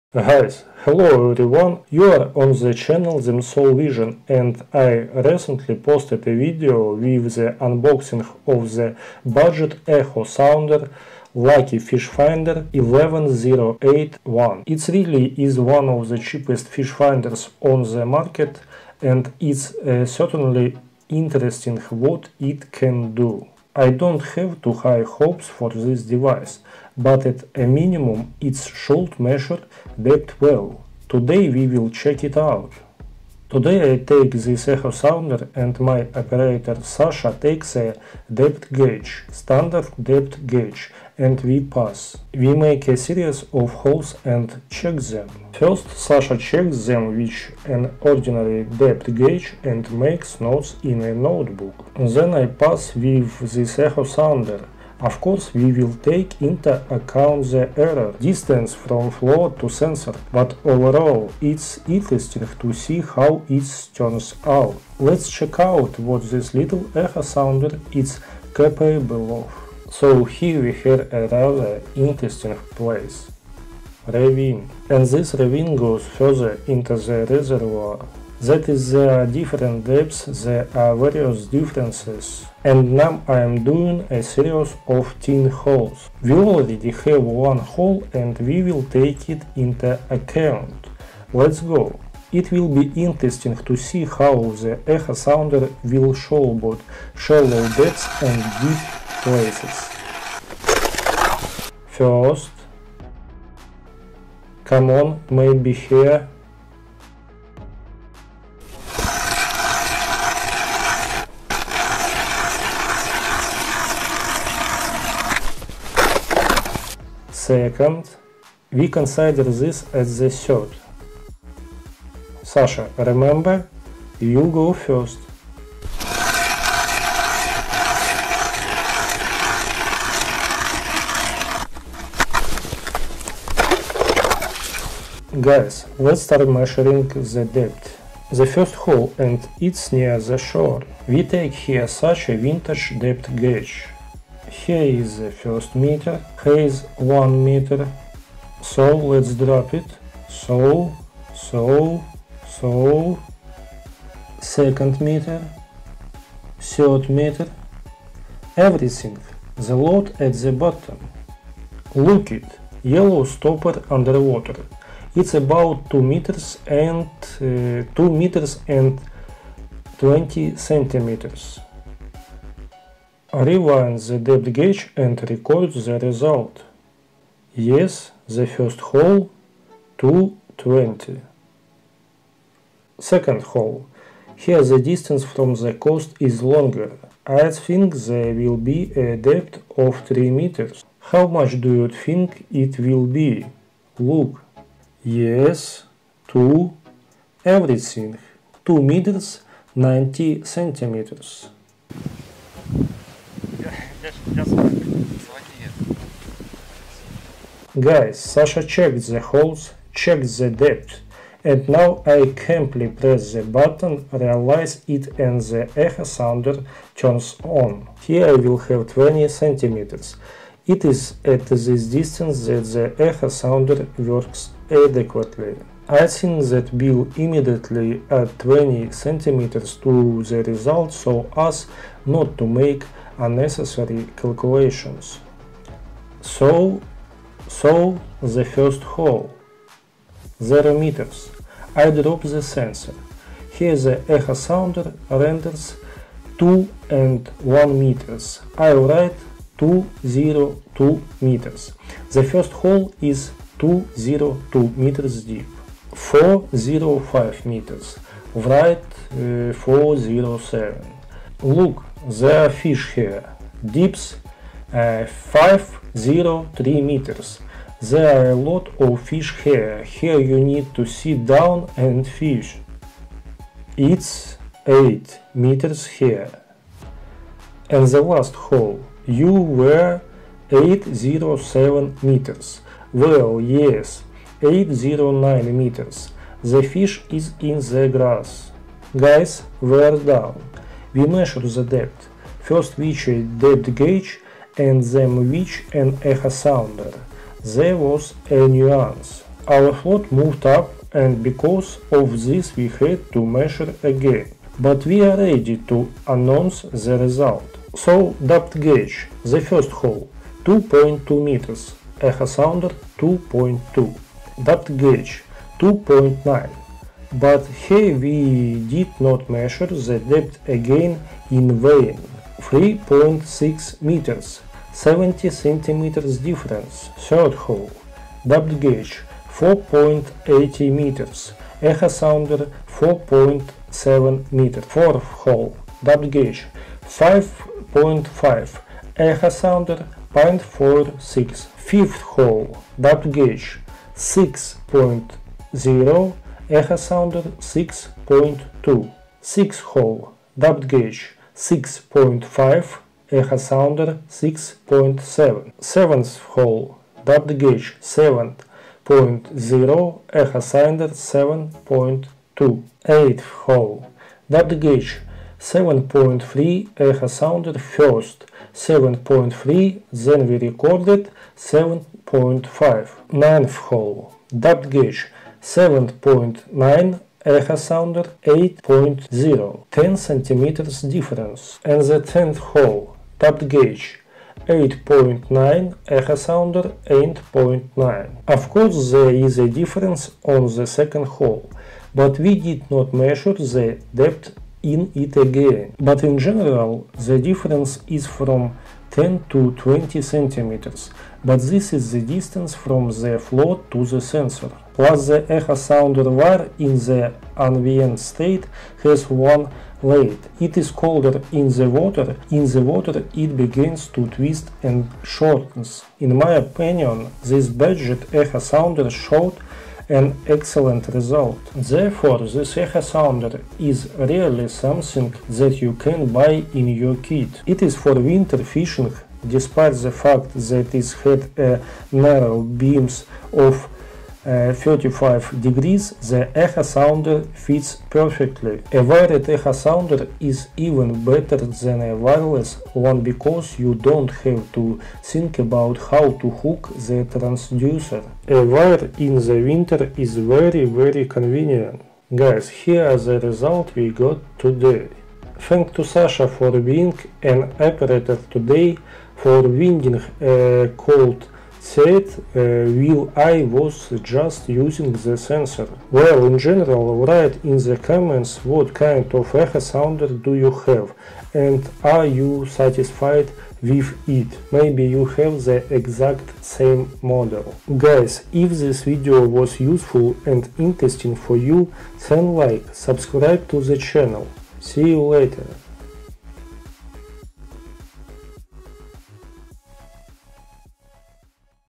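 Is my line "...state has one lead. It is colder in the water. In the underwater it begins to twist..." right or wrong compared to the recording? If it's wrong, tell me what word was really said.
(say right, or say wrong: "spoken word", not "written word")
wrong: "water", not "underwater".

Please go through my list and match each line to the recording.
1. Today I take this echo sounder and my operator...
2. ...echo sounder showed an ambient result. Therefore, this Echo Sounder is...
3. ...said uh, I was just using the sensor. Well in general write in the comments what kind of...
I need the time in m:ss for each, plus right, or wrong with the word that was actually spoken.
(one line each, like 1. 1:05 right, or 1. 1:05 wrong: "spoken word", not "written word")
1. 0:33 right
2. 6:58 wrong: "excellent", not "ambient"
3. 7:41 right.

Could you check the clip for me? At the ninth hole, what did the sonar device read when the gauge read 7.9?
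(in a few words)
8.0.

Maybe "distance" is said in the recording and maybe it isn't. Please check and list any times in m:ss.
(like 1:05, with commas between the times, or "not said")
0:58, 3:04, 3:41, 6:42.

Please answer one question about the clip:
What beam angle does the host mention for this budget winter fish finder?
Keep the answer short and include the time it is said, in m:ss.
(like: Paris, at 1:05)
35 degrees, at 7:14.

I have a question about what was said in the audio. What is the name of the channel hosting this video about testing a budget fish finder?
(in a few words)
Soul Vision.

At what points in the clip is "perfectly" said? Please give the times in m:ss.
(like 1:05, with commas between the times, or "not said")
7:17.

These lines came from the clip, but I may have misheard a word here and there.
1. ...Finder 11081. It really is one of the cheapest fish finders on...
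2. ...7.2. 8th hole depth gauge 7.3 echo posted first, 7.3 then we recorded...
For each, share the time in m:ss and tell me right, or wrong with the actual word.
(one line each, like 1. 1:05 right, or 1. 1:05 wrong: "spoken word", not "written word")
1. 0:12 right
2. 6:00 wrong: "sounded", not "posted".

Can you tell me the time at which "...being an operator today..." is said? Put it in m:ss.
7:36.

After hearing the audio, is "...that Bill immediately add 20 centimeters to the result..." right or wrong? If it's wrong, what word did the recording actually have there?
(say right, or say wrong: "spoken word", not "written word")
right.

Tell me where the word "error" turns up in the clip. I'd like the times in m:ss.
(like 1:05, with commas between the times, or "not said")
0:57.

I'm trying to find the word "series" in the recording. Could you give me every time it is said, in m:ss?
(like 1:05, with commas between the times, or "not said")
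0:42, 1:24.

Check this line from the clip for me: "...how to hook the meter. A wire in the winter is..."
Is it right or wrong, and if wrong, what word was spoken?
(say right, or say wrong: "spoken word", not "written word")
wrong: "transducer", not "meter".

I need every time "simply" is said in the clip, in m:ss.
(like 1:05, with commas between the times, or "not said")
3:32.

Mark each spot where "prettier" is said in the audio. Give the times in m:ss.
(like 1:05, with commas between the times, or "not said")
not said.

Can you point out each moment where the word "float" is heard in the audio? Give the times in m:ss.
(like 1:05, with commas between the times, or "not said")
4:59, 6:43.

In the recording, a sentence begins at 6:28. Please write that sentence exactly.
Of course there is a difference on the second hole, but we did not measure the depth in it again.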